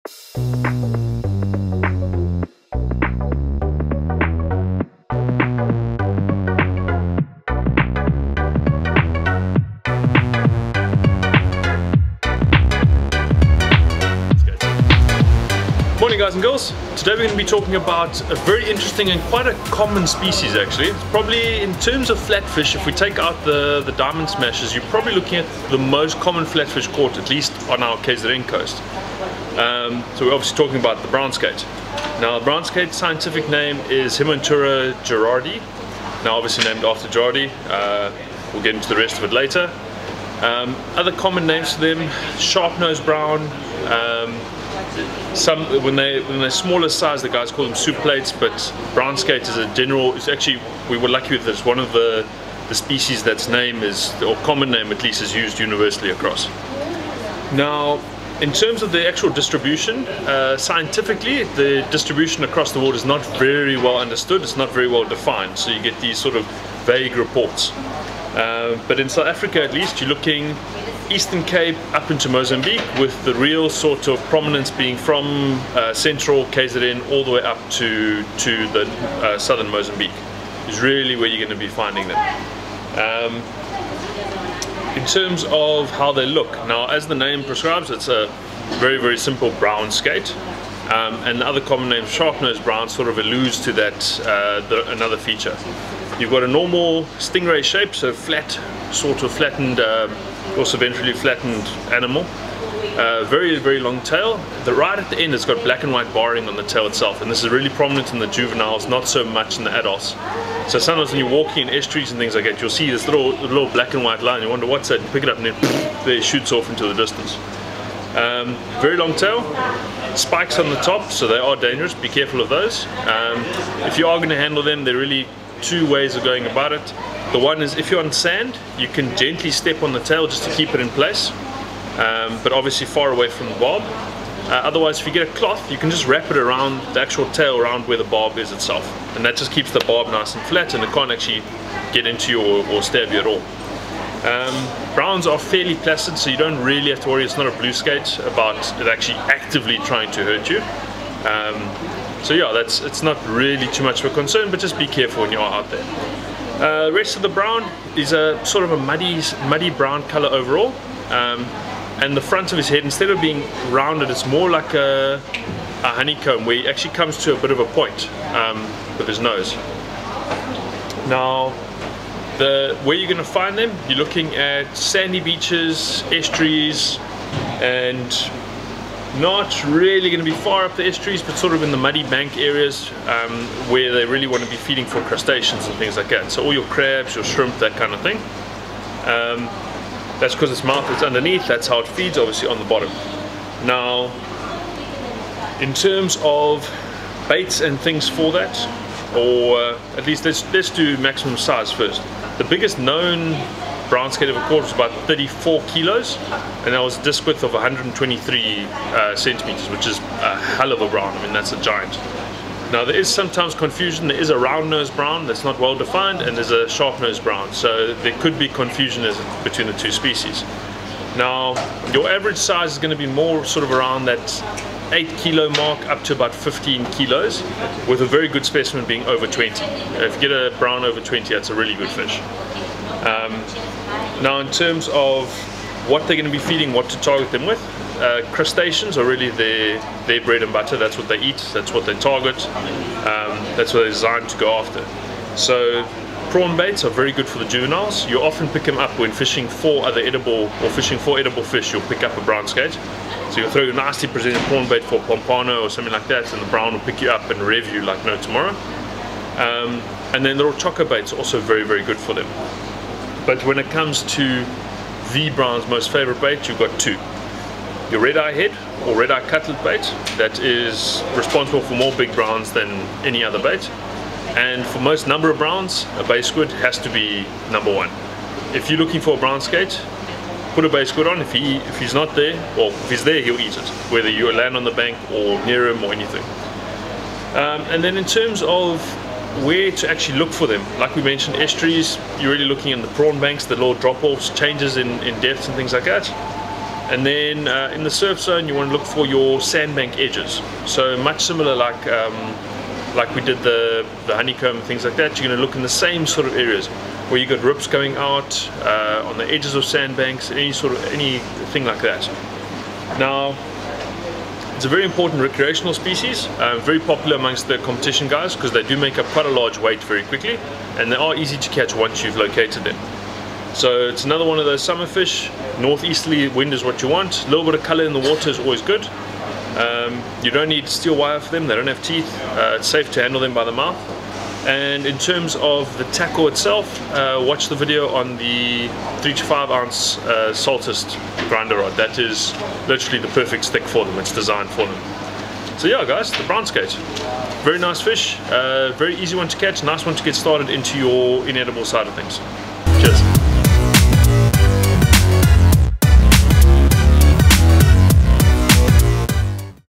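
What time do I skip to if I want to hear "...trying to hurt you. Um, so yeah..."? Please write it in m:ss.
2:29.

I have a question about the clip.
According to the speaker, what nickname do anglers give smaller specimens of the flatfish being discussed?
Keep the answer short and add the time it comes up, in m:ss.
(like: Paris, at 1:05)
soup plates, at 0:47.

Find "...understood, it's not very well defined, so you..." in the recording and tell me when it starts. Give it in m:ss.
1:03.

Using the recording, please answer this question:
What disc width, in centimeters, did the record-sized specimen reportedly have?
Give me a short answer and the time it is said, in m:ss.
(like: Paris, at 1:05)
123, at 3:27.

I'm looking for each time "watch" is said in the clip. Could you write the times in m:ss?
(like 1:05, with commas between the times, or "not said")
5:37.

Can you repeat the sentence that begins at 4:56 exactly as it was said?
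And then uh, in the surf zone, you want to look for your sandbank edges.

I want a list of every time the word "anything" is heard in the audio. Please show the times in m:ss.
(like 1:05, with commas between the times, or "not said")
4:45, 5:10.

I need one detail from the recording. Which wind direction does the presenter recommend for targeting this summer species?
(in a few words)
northeasterly.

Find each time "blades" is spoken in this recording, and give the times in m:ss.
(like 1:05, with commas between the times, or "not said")
not said.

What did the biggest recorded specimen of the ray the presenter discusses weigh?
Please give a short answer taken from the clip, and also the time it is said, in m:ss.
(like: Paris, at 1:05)
34 kilos, at 3:25.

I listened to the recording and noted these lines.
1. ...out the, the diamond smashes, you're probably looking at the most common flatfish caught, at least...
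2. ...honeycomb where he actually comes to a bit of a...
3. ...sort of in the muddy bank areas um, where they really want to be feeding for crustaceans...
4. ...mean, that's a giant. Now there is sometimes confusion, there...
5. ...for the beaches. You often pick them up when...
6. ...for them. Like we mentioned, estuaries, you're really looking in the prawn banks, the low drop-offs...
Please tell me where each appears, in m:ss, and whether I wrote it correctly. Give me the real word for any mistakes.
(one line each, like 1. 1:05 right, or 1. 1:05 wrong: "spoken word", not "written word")
1. 0:23 right
2. 2:45 right
3. 3:01 right
4. 3:31 right
5. 4:07 wrong: "juveniles", not "beaches"
6. 4:50 right.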